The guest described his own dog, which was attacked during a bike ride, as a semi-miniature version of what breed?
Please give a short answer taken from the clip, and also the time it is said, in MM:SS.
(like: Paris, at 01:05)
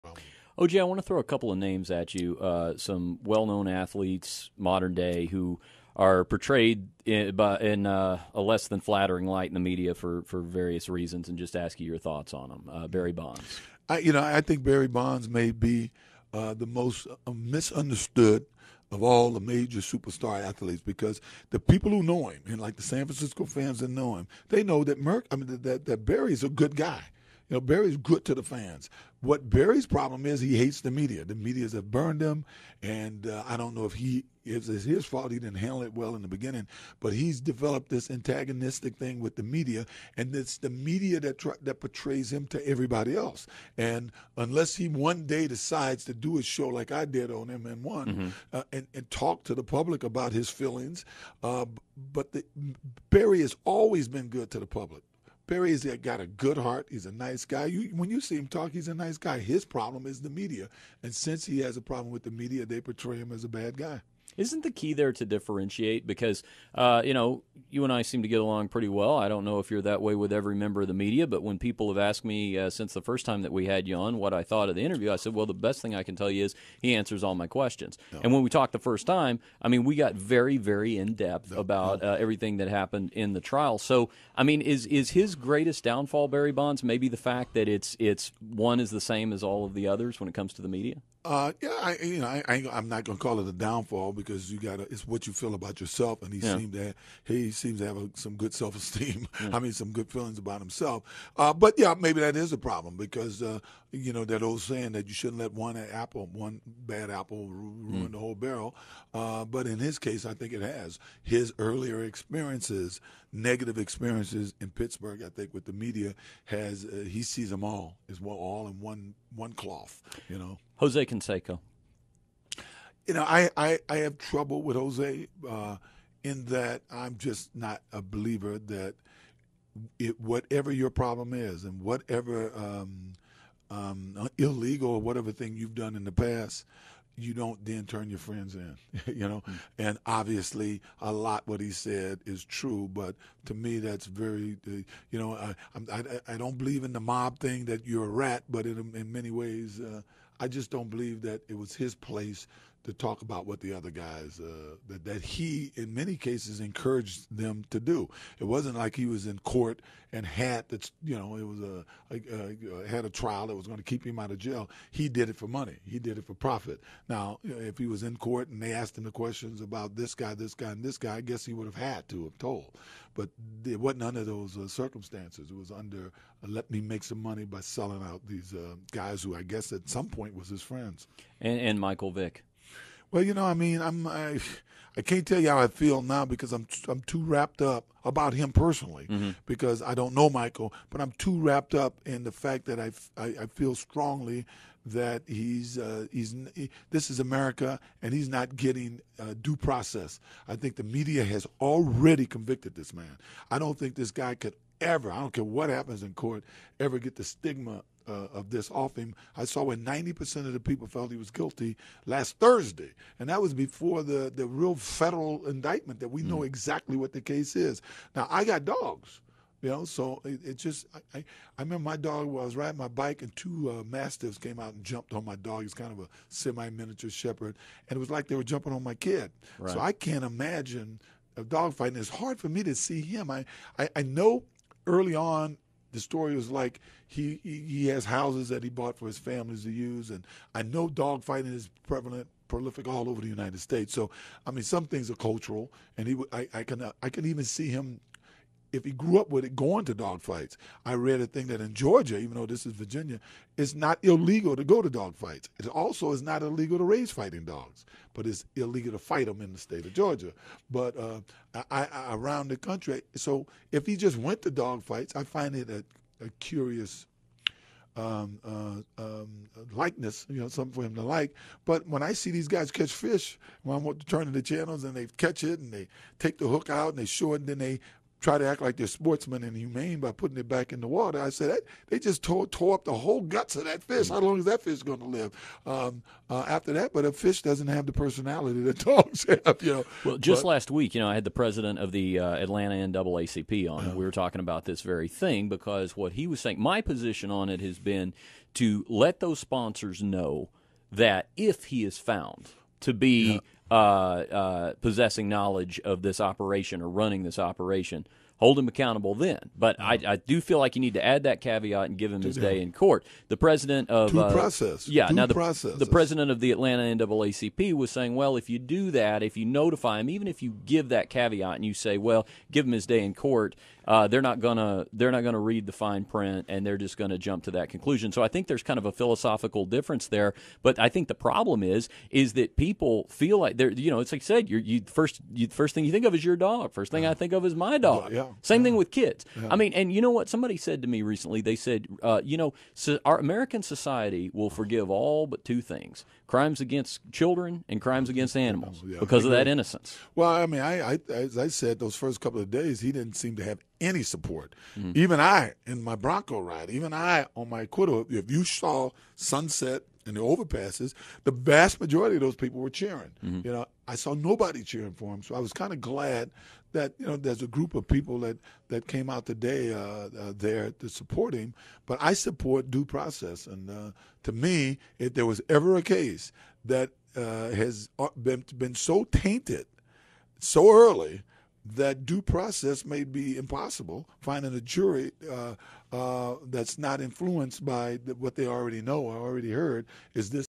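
Shepherd, at 03:47.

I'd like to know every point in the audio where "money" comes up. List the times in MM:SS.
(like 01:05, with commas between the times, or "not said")
02:45, 02:57.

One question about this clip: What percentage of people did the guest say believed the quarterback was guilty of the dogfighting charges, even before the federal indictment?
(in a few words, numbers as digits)
90%.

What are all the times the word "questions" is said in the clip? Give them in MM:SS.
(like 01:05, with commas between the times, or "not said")
01:17, 02:49.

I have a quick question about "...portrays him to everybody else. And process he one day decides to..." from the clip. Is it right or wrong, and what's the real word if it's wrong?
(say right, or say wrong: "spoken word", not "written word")
wrong: "unless", not "process".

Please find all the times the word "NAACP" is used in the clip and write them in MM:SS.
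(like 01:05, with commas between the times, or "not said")
04:52, 05:17.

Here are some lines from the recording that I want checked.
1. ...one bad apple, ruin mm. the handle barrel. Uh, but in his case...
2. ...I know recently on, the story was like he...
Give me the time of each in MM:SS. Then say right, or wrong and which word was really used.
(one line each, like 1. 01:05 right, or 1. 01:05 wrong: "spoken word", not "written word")
1. 01:46 wrong: "whole", not "handle"
2. 03:53 wrong: "early", not "recently".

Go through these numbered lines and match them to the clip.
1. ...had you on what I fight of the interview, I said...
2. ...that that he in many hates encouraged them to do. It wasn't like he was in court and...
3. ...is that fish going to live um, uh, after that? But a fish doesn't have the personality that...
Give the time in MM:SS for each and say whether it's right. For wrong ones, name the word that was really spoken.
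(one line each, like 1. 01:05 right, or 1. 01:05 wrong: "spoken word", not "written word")
1. 01:13 wrong: "thought", not "fight"
2. 02:34 wrong: "cases", not "hates"
3. 04:44 right.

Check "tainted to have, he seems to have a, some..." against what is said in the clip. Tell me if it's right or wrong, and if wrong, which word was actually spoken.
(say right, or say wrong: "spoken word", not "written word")
wrong: "seemed", not "tainted".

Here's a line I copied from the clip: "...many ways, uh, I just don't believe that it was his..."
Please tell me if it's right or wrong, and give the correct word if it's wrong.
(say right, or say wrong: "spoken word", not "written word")
right.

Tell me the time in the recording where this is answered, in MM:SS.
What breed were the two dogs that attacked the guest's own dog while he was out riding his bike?
03:43.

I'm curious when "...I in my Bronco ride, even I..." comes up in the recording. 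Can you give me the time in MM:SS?
05:55.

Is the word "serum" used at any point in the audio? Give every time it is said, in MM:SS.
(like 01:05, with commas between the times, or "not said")
not said.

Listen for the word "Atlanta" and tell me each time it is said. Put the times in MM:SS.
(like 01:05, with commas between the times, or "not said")
04:52, 05:16.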